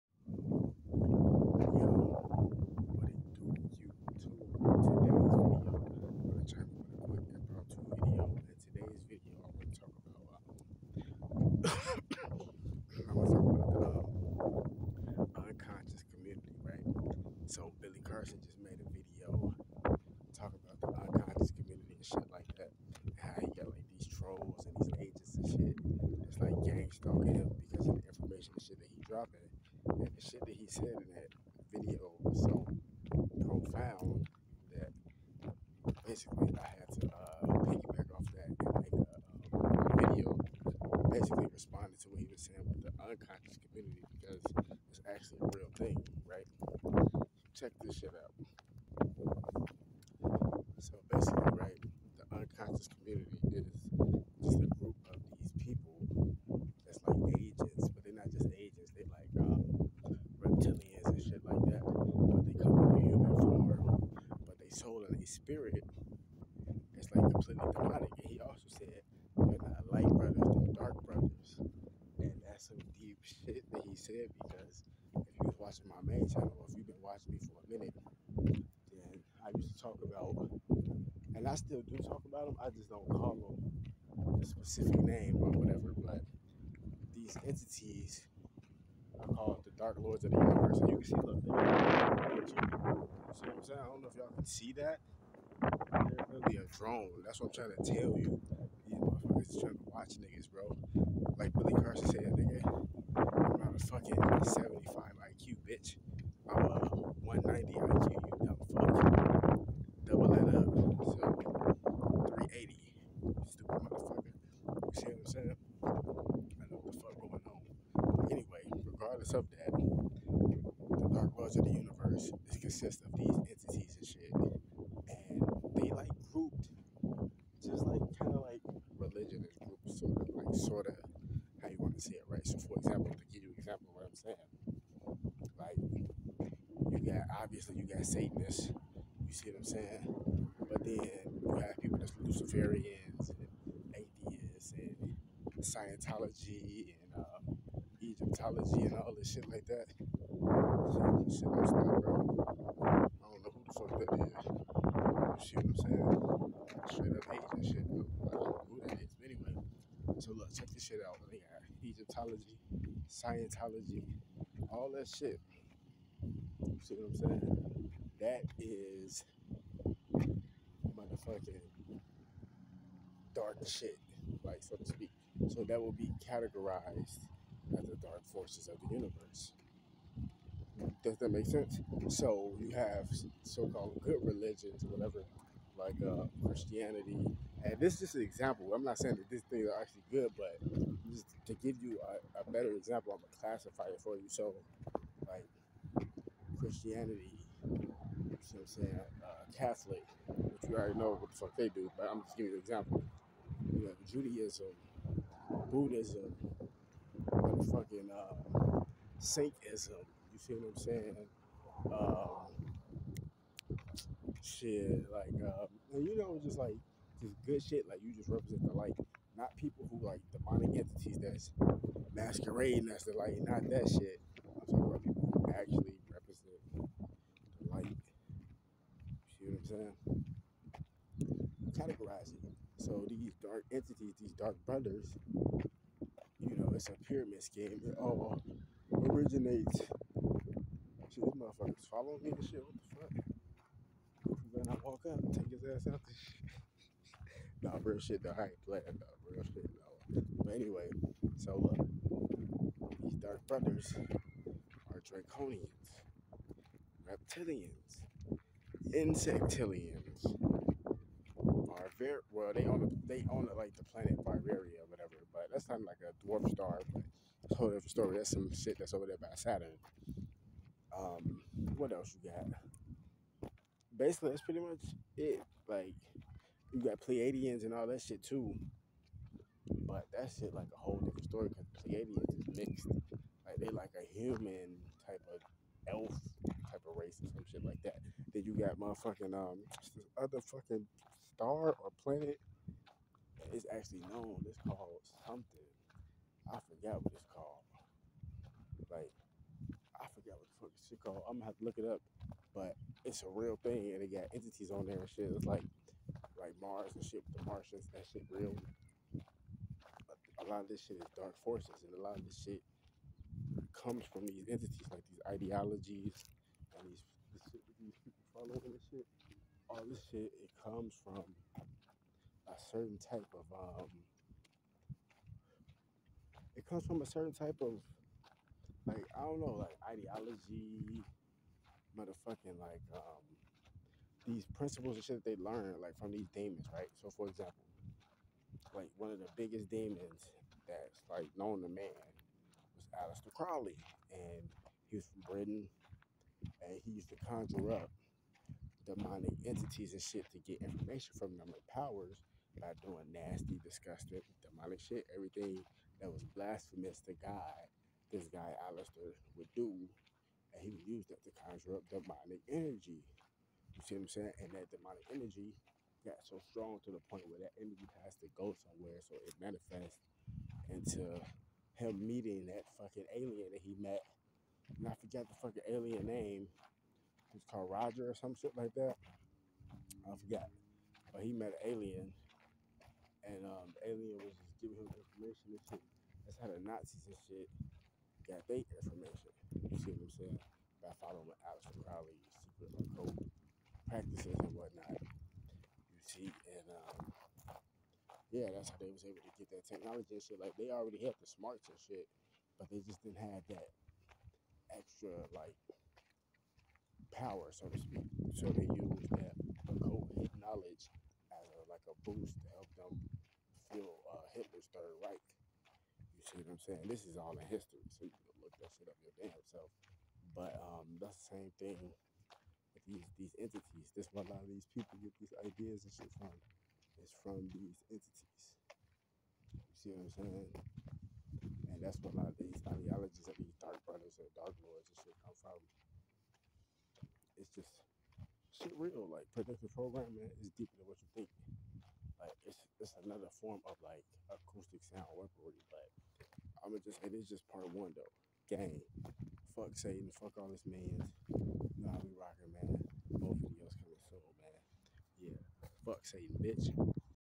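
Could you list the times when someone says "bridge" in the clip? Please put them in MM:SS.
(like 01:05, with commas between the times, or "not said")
not said.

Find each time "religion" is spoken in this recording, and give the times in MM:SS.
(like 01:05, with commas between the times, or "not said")
02:08, 03:04.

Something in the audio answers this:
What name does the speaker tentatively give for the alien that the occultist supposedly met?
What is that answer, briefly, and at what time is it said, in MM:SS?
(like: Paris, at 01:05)
Roger, at 06:17.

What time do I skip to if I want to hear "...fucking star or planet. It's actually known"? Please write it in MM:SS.
04:50.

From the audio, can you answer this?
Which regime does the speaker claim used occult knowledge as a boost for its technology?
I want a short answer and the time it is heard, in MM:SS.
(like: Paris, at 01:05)
Hitler's Third Reich, at 06:54.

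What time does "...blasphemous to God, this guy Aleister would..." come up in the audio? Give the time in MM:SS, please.
05:56.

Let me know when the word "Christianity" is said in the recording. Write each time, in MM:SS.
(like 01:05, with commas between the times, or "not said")
03:06, 03:16.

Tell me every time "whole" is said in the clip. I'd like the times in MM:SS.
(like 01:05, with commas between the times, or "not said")
04:27, 04:40.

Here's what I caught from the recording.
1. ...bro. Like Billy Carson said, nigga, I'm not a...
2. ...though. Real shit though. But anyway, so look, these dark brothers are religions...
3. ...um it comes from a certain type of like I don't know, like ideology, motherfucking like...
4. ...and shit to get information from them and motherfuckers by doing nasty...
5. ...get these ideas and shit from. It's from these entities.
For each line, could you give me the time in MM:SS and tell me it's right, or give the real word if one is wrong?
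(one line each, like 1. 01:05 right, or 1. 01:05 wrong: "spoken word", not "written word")
1. 01:40 right
2. 04:08 wrong: "draconians", not "religions"
3. 05:23 right
4. 05:49 wrong: "powers", not "motherfuckers"
5. 07:05 right.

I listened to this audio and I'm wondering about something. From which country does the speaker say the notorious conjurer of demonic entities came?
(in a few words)
Britain.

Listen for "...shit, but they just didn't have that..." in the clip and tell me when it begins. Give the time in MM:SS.
06:41.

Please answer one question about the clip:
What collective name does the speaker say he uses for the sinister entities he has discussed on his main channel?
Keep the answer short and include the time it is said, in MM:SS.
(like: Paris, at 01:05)
Dark Lords of the Universe, at 01:29.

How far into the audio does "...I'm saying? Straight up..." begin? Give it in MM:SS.
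02:35.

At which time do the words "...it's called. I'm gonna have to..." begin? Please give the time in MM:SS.
05:00.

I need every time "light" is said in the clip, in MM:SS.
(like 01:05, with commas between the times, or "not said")
01:09, 03:38, 03:43, 03:47.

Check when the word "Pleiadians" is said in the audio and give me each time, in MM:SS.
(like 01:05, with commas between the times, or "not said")
04:36, 04:41.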